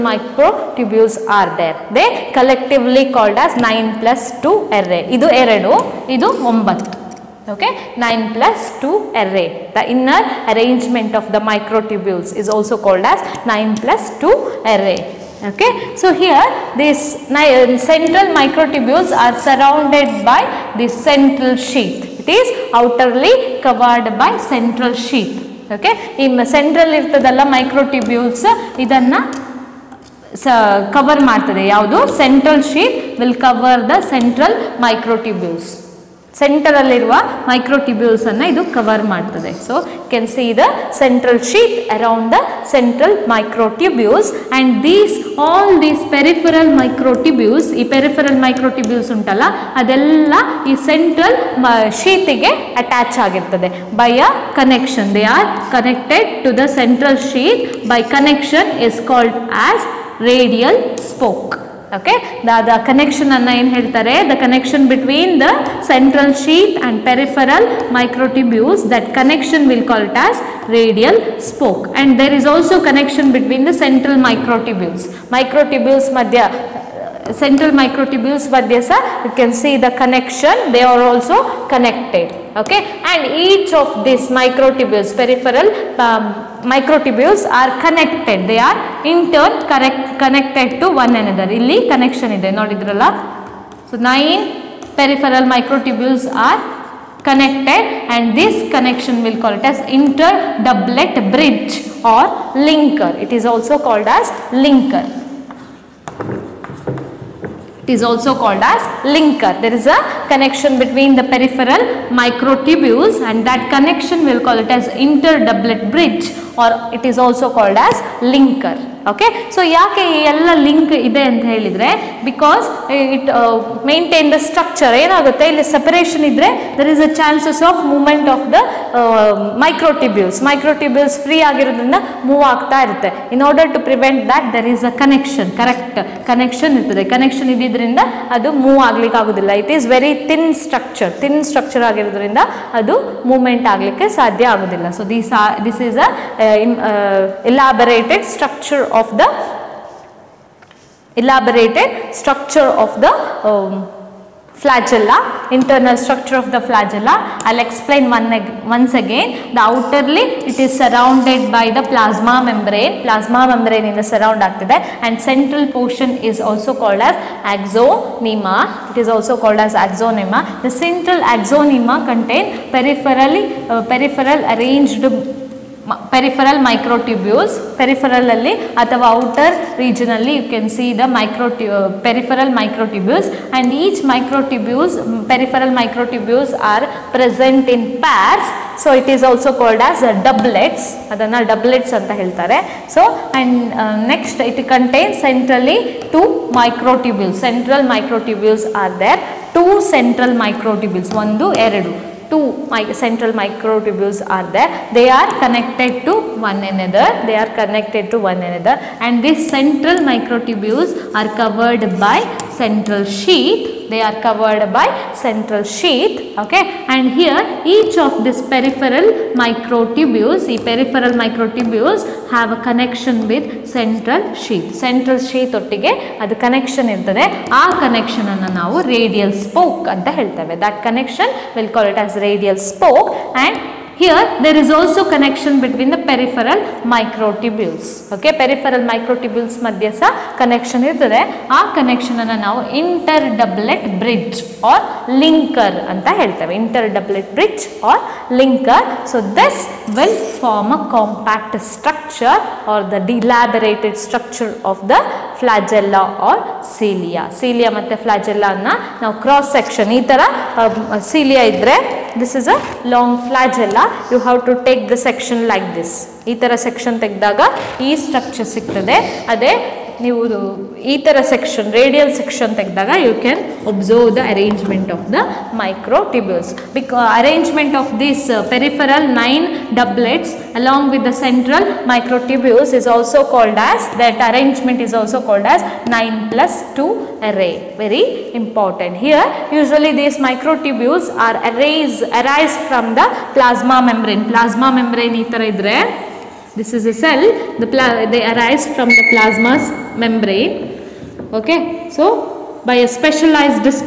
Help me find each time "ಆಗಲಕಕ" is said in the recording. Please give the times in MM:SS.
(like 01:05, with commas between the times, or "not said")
02:18, 02:23.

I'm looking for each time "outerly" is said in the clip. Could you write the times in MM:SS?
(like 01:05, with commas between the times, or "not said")
00:22, 02:39.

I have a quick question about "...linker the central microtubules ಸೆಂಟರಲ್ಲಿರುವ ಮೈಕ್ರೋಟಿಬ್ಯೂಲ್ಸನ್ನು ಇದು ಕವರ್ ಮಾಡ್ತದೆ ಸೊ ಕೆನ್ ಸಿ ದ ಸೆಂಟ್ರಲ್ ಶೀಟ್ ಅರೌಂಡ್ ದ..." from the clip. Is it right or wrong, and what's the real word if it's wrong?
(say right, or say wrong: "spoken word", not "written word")
wrong: "cover", not "linker".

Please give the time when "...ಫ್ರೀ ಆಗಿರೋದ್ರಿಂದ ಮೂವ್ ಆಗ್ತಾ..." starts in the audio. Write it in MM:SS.
02:11.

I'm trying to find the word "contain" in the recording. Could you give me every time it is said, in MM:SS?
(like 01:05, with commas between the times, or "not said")
02:52.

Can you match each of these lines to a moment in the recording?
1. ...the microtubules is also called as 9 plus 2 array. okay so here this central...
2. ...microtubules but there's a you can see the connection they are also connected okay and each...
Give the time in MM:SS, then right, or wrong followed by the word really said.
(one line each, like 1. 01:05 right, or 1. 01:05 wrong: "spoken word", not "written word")
1. 00:11 right
2. 01:17 right.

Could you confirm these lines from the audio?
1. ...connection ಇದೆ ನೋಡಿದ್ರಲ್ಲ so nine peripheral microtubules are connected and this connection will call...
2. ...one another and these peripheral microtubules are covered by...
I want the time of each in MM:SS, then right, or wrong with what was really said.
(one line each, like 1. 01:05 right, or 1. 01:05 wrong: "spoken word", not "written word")
1. 01:31 right
2. 03:28 wrong: "central", not "peripheral".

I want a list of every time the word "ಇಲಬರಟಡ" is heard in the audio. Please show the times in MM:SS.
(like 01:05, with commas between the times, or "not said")
02:27.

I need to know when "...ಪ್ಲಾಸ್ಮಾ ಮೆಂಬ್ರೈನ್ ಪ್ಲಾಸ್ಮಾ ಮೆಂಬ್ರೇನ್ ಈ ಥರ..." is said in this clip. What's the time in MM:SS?
04:53.